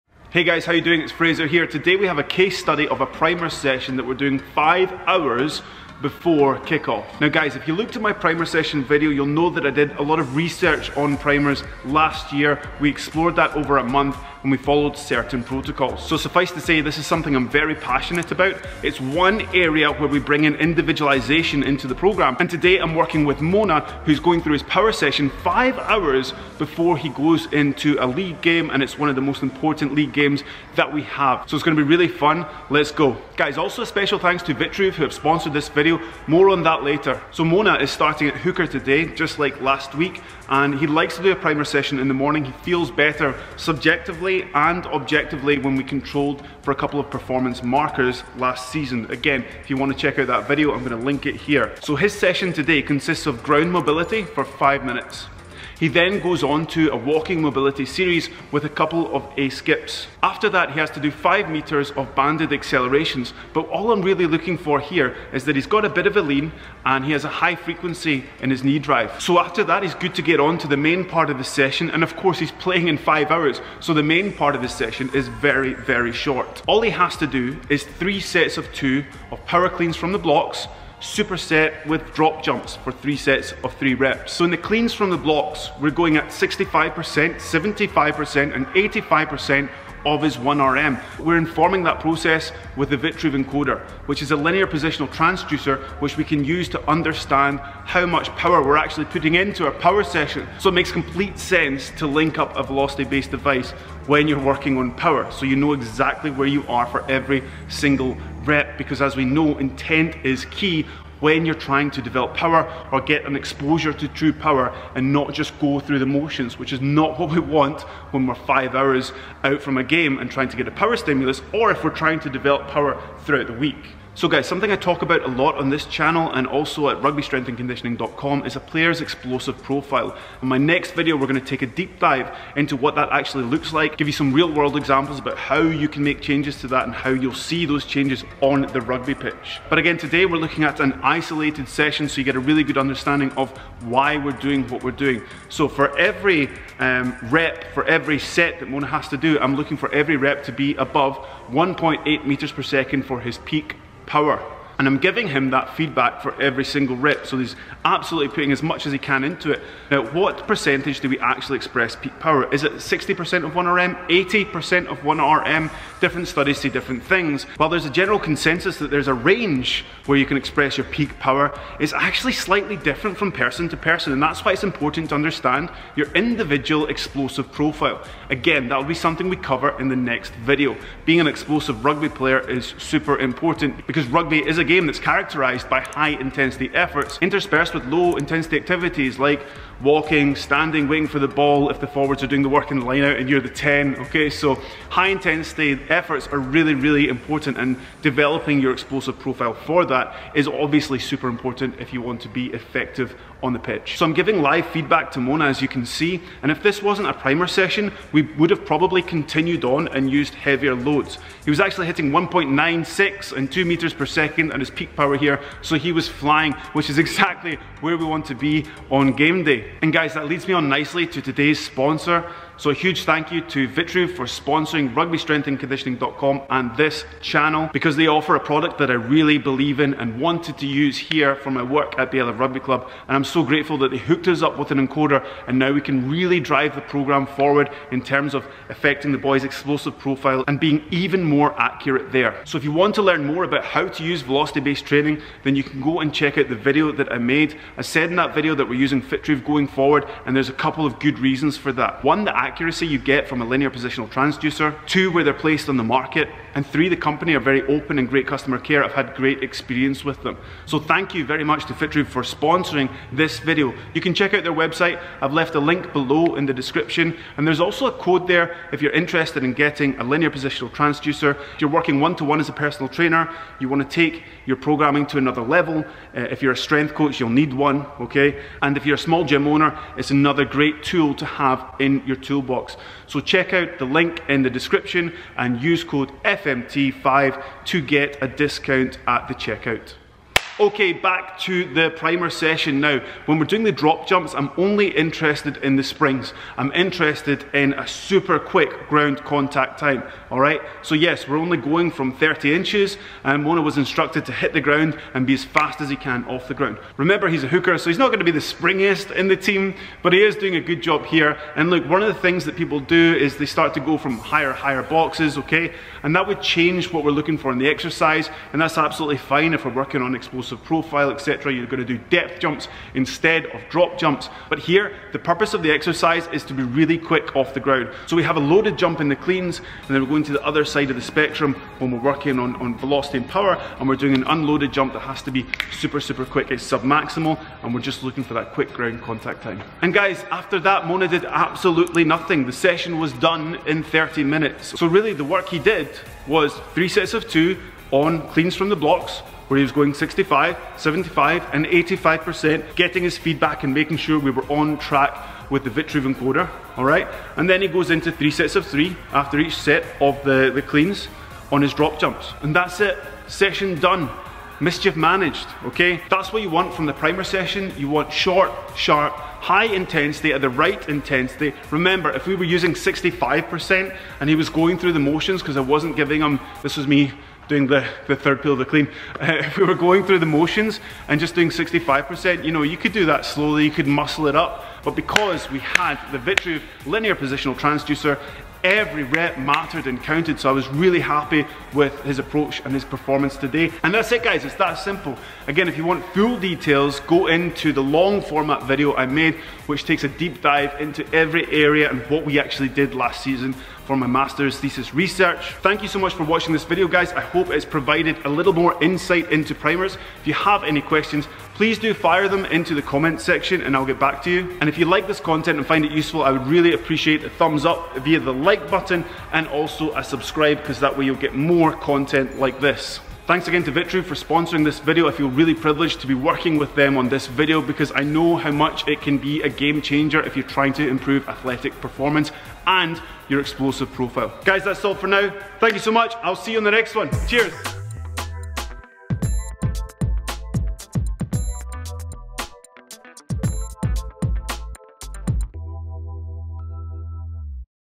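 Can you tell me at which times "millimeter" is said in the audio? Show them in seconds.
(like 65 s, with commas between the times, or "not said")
not said.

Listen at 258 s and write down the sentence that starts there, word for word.
I've had great experience with them.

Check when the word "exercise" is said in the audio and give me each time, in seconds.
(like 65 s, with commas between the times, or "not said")
317 s, 325 s.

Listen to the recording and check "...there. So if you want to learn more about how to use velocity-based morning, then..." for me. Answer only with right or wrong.
wrong.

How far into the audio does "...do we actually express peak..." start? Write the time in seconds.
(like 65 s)
161 s.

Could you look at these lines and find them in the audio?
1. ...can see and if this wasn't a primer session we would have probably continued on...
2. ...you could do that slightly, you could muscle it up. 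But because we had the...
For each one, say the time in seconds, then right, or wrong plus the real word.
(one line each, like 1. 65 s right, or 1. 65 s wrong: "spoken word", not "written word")
1. 205 s right
2. 382 s wrong: "slowly", not "slightly".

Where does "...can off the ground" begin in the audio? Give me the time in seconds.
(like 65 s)
305 s.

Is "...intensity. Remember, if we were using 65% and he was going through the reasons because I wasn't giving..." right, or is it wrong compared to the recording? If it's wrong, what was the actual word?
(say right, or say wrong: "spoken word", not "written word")
wrong: "motions", not "reasons".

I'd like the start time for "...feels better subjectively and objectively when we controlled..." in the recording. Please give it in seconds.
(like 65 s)
42 s.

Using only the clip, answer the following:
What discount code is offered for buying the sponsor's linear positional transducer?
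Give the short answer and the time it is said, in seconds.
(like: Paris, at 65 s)
FMT5, at 286 s.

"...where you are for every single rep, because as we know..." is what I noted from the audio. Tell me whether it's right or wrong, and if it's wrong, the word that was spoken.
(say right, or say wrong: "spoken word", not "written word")
right.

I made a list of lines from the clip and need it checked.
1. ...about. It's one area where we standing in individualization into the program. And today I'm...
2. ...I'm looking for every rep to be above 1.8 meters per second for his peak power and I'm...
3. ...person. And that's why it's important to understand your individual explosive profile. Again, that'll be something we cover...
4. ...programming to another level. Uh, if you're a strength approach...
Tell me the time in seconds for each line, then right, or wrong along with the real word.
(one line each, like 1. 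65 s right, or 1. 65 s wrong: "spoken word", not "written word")
1. 18 s wrong: "bring", not "standing"
2. 149 s right
3. 173 s right
4. 274 s wrong: "coach", not "approach".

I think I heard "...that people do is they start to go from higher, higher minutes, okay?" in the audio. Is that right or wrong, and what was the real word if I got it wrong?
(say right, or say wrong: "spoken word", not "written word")
wrong: "boxes", not "minutes".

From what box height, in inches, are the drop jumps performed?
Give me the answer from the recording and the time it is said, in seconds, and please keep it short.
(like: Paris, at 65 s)
30 inches, at 302 s.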